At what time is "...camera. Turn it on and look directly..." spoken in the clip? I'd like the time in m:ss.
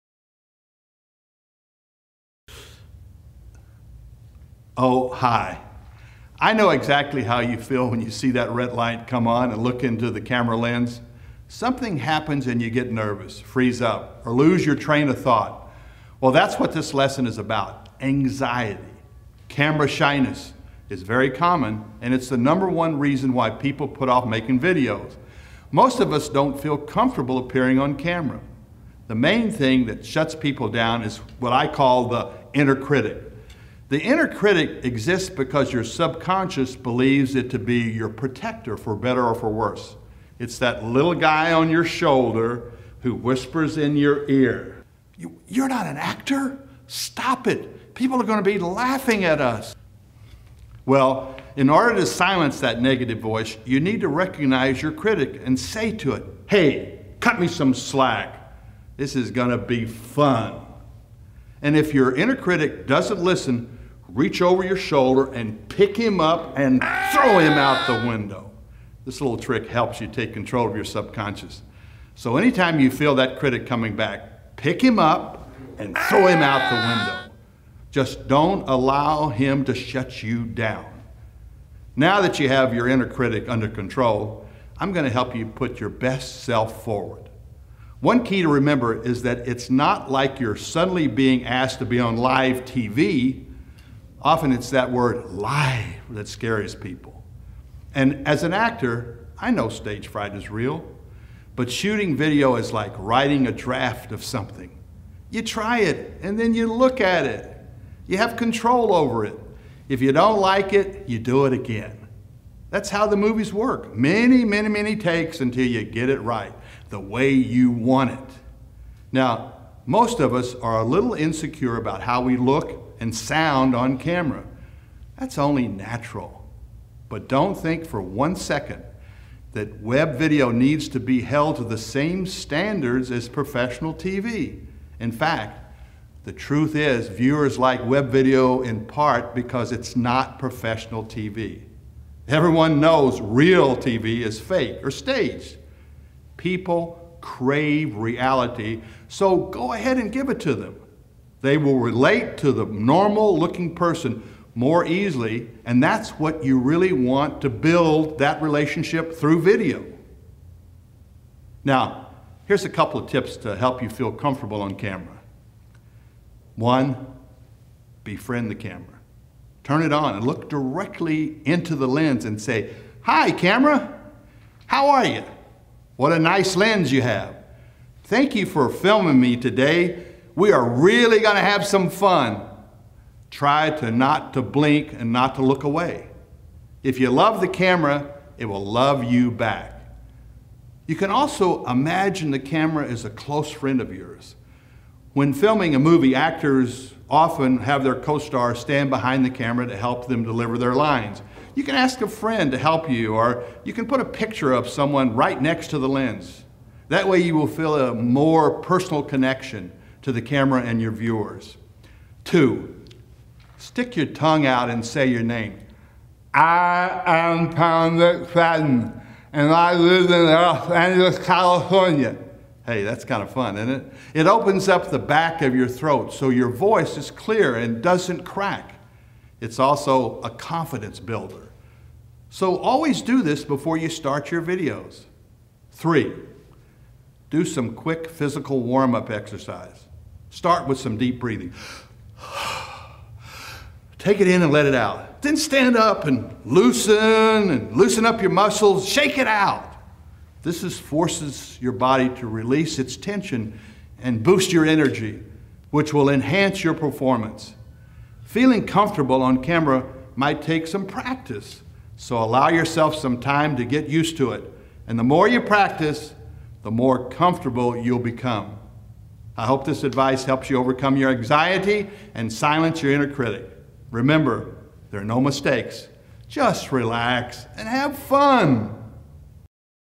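2:48.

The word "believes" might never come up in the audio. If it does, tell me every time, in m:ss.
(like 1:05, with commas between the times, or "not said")
0:36.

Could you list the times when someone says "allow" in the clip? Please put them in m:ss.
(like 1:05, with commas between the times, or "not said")
1:18, 4:22.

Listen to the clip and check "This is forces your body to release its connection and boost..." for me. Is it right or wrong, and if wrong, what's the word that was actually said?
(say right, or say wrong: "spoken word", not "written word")
wrong: "tension", not "connection".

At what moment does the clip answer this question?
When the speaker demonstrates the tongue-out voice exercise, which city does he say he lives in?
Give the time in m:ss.
3:40.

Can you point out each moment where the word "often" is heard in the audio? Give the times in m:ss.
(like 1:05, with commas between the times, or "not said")
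1:34, 3:17.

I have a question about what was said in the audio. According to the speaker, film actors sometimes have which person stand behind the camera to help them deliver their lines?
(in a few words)
Their co-star.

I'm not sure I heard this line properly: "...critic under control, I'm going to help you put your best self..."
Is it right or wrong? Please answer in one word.
right.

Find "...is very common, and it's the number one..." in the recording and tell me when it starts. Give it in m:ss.
0:20.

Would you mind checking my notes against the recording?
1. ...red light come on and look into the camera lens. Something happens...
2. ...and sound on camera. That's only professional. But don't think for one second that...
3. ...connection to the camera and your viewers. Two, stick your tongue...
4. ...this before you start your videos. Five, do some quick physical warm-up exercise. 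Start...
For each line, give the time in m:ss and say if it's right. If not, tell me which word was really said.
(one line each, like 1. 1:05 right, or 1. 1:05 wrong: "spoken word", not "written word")
1. 0:08 right
2. 2:03 wrong: "natural", not "professional"
3. 3:29 right
4. 3:53 wrong: "Three", not "Five".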